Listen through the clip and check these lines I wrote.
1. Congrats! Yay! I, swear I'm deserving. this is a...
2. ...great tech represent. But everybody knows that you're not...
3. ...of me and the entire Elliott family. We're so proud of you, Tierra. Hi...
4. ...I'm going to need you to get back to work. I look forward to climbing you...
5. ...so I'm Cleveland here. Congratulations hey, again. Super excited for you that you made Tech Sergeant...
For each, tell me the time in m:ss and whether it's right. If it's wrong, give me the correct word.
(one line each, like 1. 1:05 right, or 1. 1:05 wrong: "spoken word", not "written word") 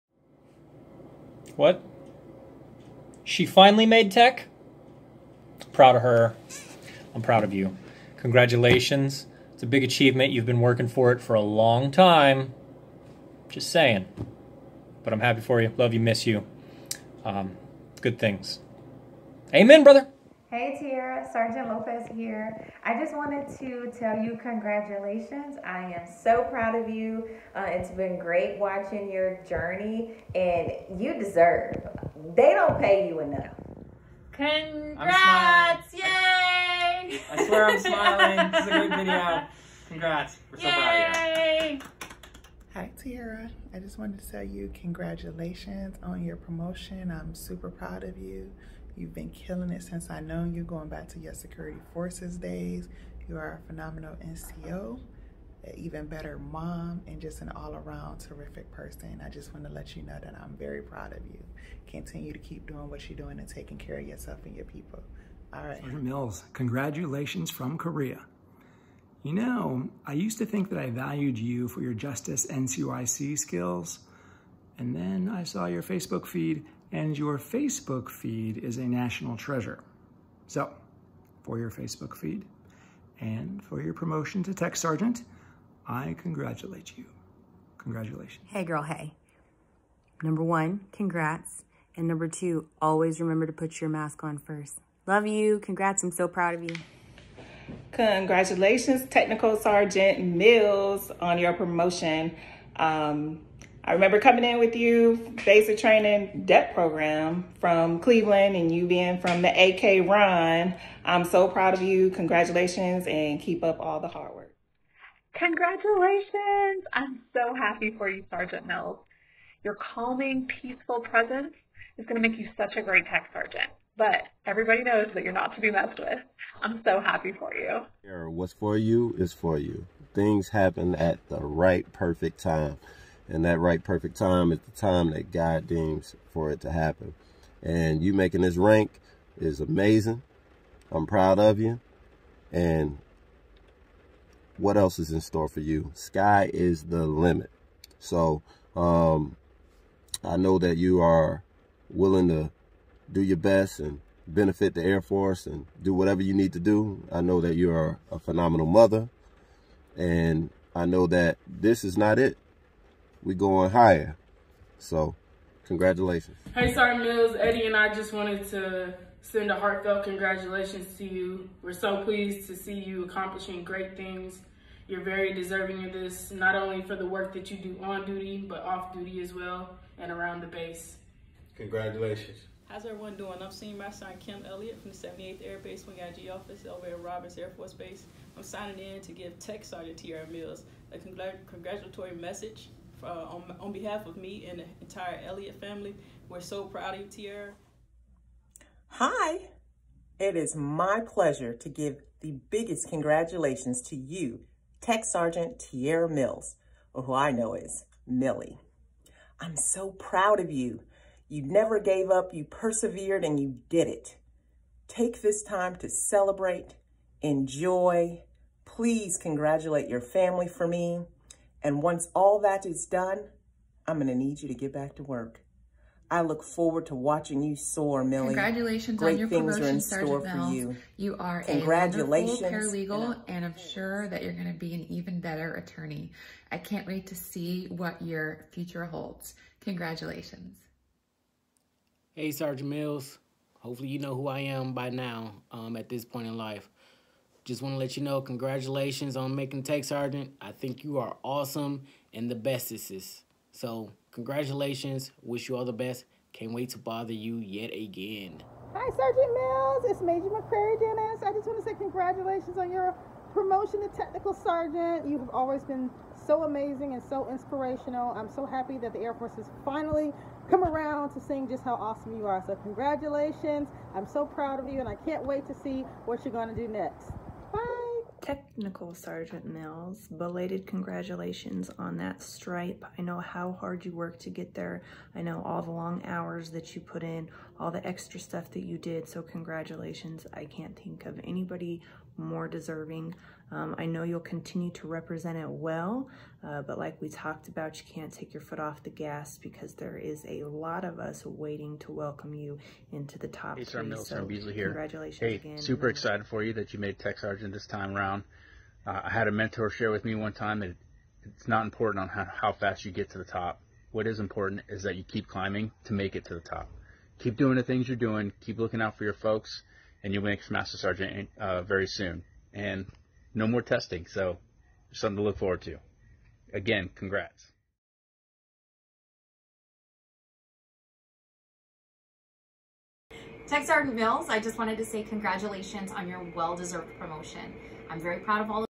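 1. 0:34 wrong: "smiling", not "deserving"
2. 2:02 wrong: "sergeant", not "represent"
3. 3:14 right
4. 3:43 wrong: "watching", not "climbing"
5. 5:04 wrong: "Beasley", not "Cleveland".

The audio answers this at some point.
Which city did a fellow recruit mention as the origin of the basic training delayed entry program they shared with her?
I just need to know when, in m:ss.
1:47.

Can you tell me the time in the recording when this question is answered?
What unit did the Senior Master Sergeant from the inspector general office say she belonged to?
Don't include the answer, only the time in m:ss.
3:04.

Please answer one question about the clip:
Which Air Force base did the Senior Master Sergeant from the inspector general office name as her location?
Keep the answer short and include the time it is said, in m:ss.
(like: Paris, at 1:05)
Robins Air Force Base, at 3:07.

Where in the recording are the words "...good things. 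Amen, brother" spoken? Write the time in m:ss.
0:18.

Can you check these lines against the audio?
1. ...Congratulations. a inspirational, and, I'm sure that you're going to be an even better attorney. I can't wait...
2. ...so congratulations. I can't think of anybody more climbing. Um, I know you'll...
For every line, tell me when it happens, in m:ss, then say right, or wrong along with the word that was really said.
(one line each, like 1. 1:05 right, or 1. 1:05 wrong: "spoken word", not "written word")
1. 3:51 wrong: "paralegal", not "inspirational"
2. 4:49 wrong: "deserving", not "climbing".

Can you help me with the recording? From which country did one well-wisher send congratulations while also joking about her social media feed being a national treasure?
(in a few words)
Korea.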